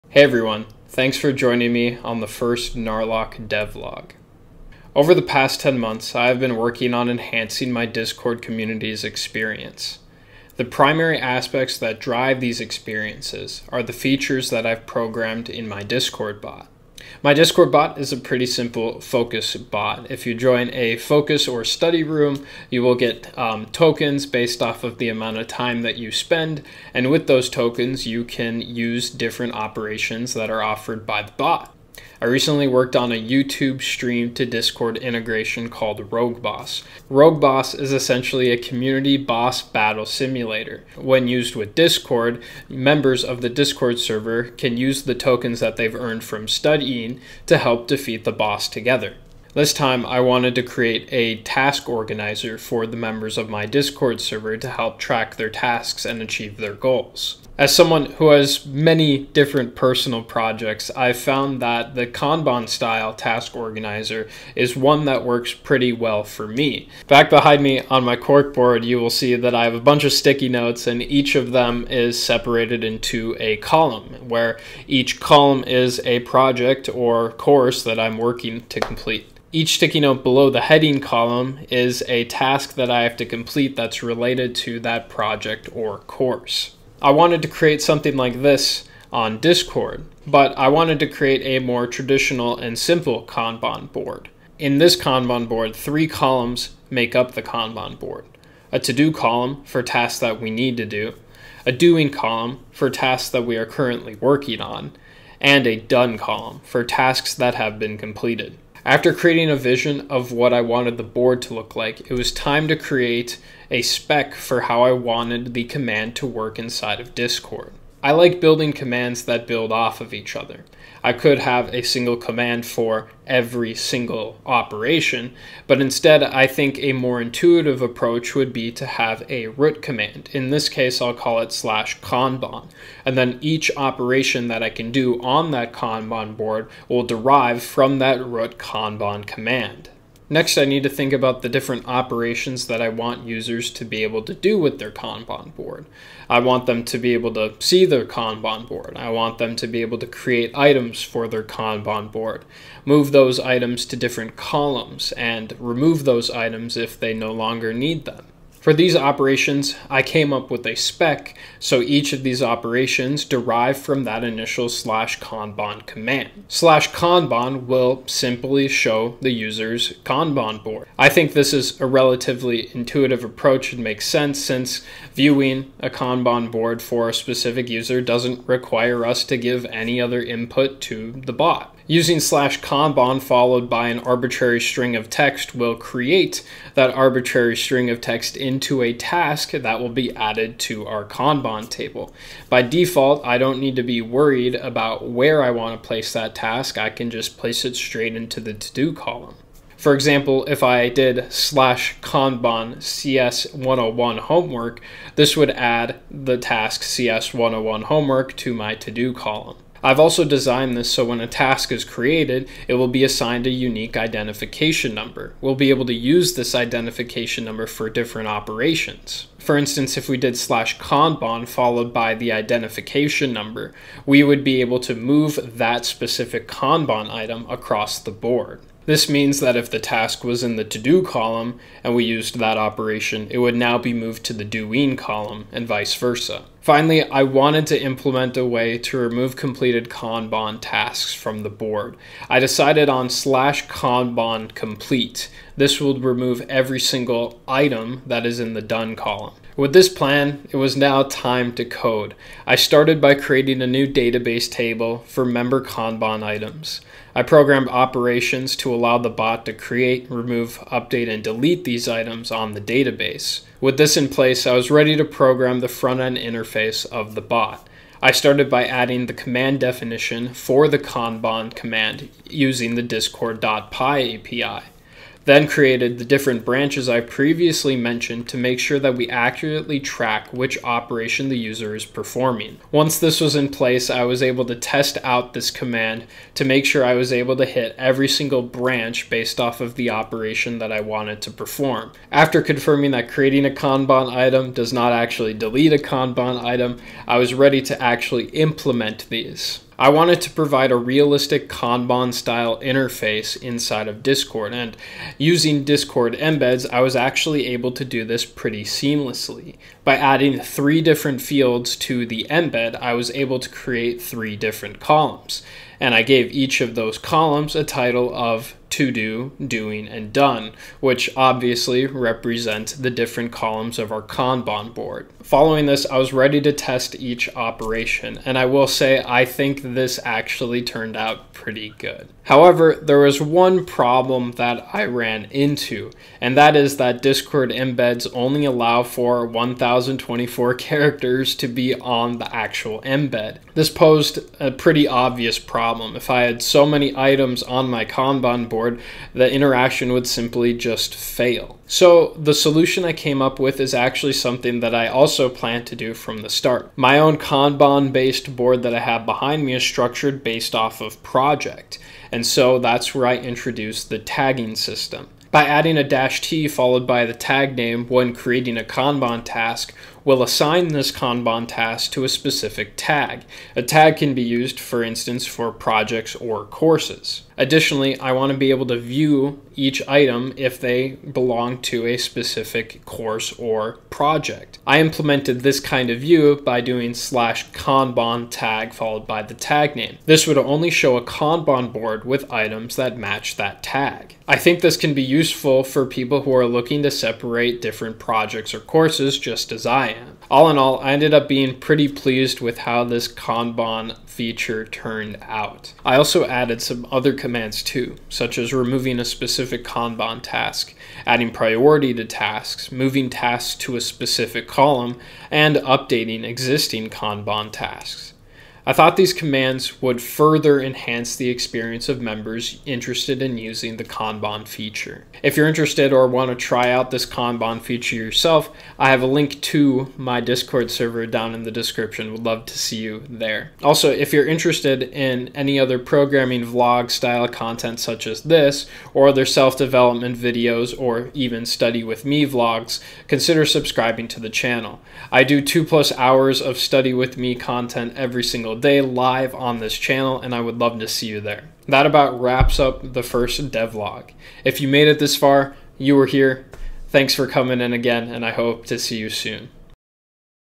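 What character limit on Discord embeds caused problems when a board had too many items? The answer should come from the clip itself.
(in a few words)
1024.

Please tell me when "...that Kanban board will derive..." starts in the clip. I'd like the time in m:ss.
2:15.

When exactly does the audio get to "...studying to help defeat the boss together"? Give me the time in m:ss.
0:46.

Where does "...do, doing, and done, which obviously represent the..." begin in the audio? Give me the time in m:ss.
5:18.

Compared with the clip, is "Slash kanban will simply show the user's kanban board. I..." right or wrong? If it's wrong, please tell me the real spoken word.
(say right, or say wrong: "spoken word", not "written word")
right.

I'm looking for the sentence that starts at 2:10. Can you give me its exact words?
In this case, I'll call it slash Kanban.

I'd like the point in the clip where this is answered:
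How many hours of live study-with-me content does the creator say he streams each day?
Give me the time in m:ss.
7:25.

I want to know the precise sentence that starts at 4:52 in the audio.
After confirming that creating a Kanban item does not actually delete a Kanban item, I was ready to actually implement these.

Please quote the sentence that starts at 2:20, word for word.
Next, I need to think about the different operations that I want users to be able to do with their Kanban board.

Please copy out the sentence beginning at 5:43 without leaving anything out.
This posed a pretty obvious problem.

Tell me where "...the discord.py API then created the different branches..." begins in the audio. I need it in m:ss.
4:32.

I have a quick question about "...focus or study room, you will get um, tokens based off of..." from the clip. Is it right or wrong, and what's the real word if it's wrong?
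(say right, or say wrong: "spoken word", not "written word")
right.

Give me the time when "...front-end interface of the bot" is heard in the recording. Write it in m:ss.
4:25.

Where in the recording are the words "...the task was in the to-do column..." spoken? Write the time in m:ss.
3:49.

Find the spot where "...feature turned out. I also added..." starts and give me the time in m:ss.
6:44.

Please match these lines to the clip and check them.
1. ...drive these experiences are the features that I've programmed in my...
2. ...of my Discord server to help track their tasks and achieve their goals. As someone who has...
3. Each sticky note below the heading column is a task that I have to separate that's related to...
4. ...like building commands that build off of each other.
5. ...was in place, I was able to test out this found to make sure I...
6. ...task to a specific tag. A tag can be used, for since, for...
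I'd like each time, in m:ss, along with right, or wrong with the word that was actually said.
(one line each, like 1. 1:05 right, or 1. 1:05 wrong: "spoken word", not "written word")
1. 0:12 right
2. 0:53 right
3. 1:19 wrong: "complete", not "separate"
4. 1:58 right
5. 4:43 wrong: "command", not "found"
6. 6:11 wrong: "instance", not "since".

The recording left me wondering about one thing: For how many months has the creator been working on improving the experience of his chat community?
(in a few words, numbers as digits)
10.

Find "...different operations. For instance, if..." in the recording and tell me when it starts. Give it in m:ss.
3:37.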